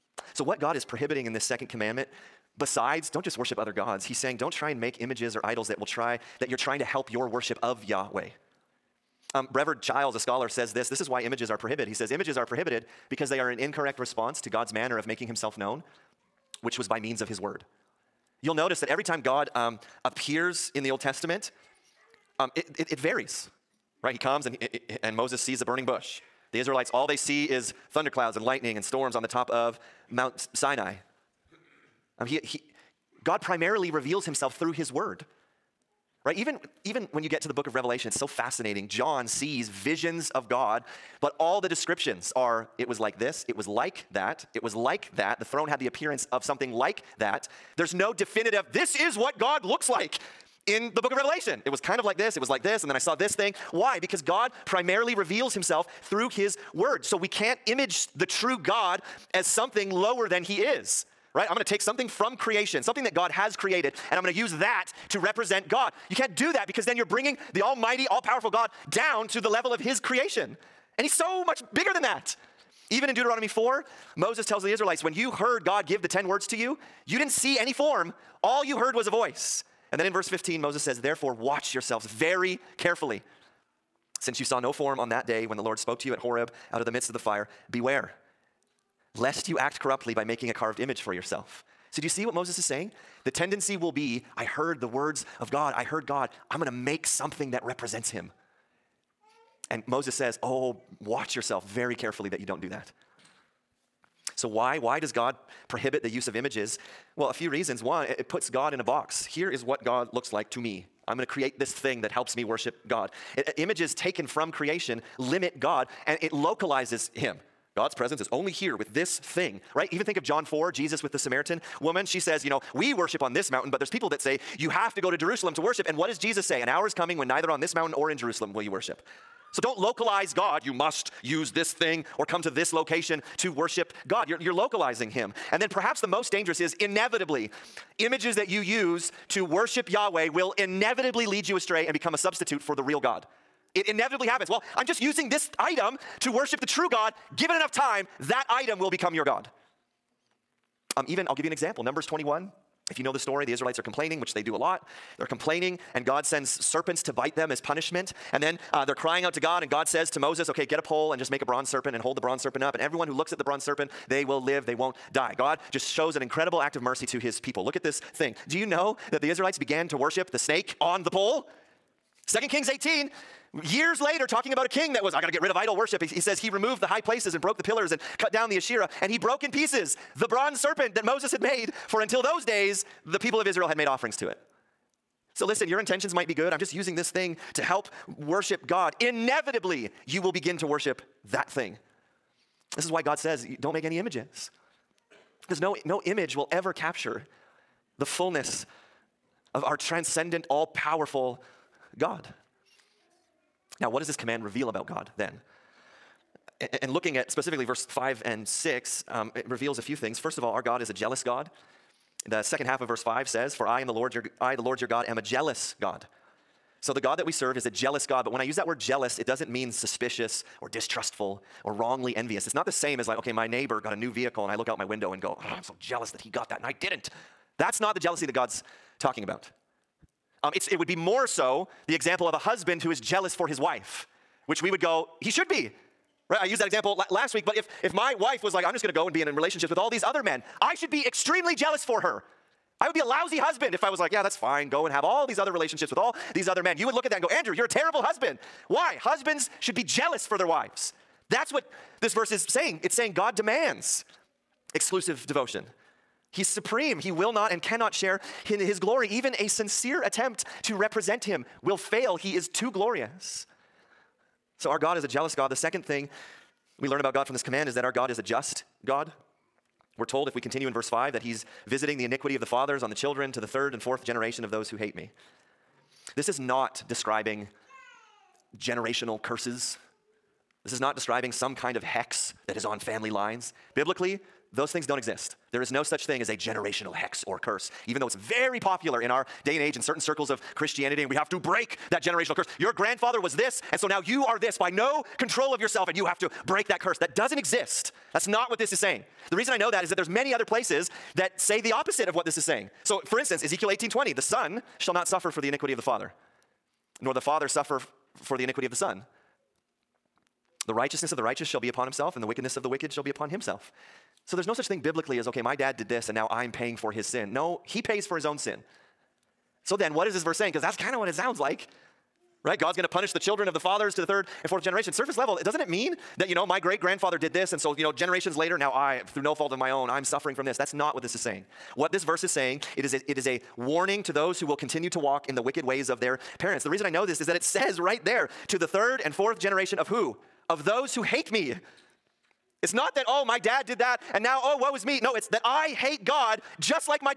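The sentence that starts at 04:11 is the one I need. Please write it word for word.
That's what this verse is saying.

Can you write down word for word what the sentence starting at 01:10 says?
And he's so much bigger than that.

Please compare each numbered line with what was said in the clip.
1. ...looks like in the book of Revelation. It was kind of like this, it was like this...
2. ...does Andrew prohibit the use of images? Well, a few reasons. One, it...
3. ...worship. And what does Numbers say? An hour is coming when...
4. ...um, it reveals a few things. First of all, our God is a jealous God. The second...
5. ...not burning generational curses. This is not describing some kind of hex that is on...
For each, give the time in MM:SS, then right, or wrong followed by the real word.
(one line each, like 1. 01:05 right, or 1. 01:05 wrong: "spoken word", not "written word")
1. 00:49 right
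2. 01:44 wrong: "God", not "Andrew"
3. 02:05 wrong: "Jesus", not "Numbers"
4. 03:29 right
5. 04:36 wrong: "describing", not "burning".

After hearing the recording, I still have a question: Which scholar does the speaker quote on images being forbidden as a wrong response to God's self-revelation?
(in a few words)
Brevard Childs.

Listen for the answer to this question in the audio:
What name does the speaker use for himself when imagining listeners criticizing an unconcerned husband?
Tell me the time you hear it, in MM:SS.
04:07.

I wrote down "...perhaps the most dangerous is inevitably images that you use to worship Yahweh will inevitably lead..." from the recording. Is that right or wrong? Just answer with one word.
right.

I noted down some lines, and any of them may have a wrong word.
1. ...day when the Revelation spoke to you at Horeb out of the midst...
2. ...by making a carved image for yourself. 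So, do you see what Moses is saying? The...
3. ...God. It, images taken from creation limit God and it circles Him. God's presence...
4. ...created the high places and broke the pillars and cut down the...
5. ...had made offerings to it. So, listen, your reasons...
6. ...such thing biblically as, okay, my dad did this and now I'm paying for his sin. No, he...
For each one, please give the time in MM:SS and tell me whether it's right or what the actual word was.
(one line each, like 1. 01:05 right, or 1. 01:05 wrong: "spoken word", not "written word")
1. 01:25 wrong: "Lord", not "Revelation"
2. 01:30 right
3. 01:52 wrong: "localizes", not "circles"
4. 02:56 wrong: "removed", not "created"
5. 03:03 wrong: "intentions", not "reasons"
6. 05:14 right.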